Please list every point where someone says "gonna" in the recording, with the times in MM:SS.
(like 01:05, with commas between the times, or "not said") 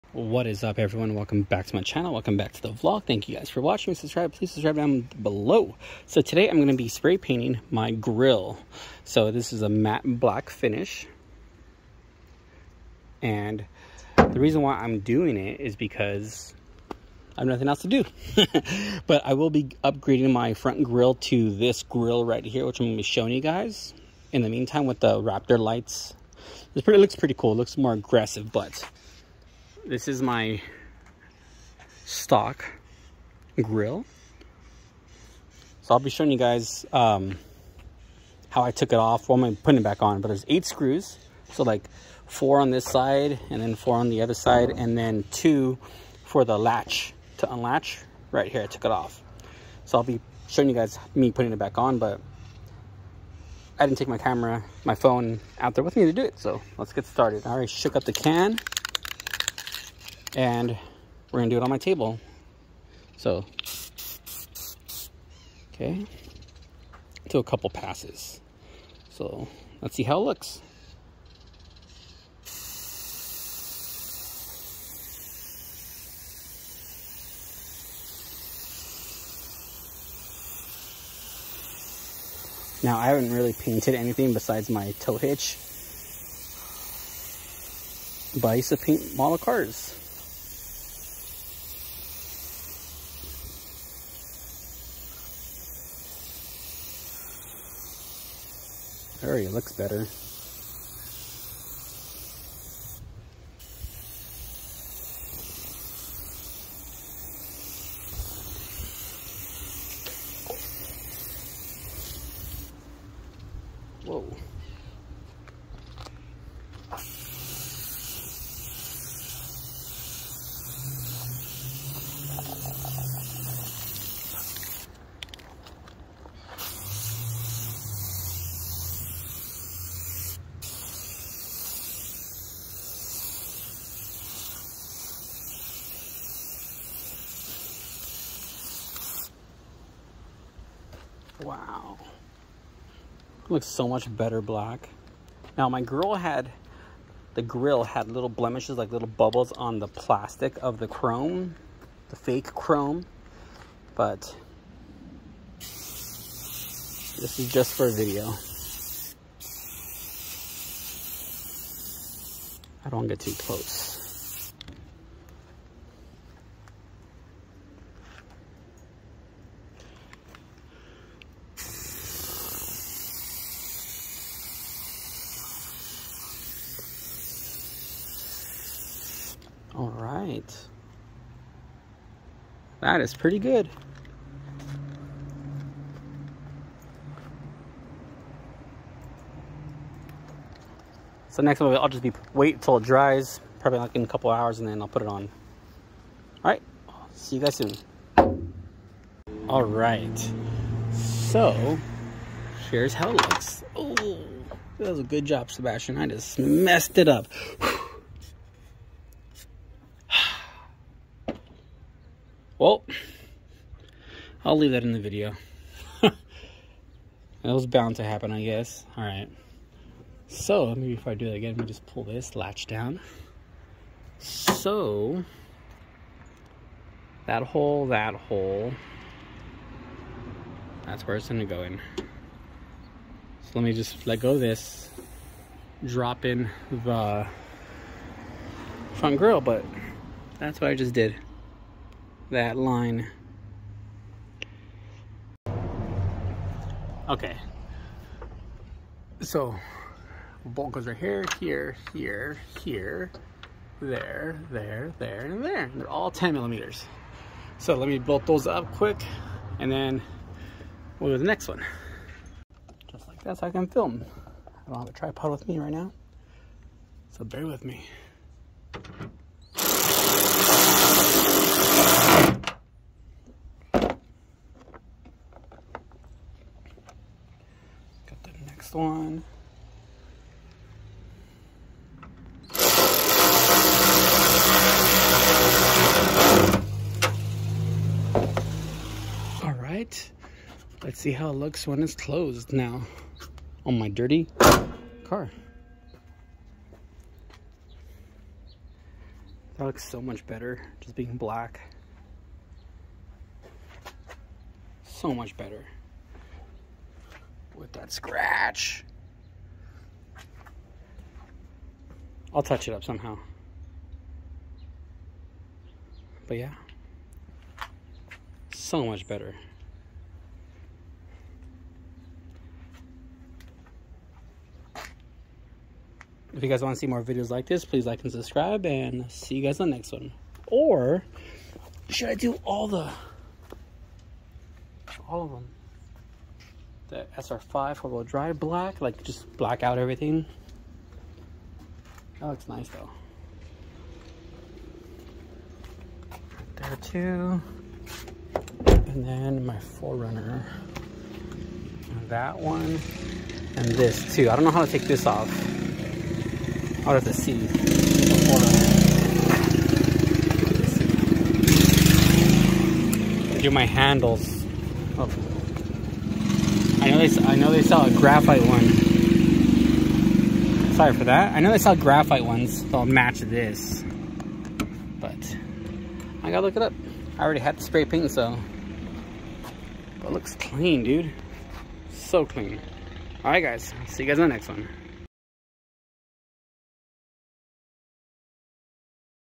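01:01, 03:51.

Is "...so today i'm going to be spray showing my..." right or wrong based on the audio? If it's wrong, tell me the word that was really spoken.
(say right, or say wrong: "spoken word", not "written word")
wrong: "painting", not "showing".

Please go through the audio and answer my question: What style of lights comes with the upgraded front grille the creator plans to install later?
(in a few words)
Raptor lights.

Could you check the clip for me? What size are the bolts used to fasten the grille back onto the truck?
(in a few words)
10 millimeters.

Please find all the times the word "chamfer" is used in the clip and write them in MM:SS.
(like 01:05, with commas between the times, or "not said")
not said.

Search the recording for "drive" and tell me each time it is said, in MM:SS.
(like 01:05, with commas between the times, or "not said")
05:38.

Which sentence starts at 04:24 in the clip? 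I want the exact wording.
I don't have a tripod with me right now, so bear with me.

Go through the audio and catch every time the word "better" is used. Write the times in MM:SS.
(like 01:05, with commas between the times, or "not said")
01:39, 02:24, 05:00, 05:05, 05:19.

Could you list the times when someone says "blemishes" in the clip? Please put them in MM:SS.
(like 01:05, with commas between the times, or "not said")
02:28.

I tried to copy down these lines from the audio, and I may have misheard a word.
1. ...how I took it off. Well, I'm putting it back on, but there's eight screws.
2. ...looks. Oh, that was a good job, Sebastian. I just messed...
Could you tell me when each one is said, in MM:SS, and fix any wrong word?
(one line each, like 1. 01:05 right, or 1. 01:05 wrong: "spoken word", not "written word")
1. 00:38 right
2. 03:23 right.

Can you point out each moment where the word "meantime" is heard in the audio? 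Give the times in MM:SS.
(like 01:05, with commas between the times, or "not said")
00:24.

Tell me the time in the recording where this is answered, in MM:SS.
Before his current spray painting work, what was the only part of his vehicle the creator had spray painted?
01:24.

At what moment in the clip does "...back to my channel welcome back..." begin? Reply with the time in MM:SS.
00:01.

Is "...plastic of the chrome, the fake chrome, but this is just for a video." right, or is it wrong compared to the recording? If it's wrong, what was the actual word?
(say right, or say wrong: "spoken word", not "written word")
right.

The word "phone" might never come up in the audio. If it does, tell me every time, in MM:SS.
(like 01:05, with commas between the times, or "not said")
00:54.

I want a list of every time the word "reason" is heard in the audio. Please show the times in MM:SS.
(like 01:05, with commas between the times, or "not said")
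00:14.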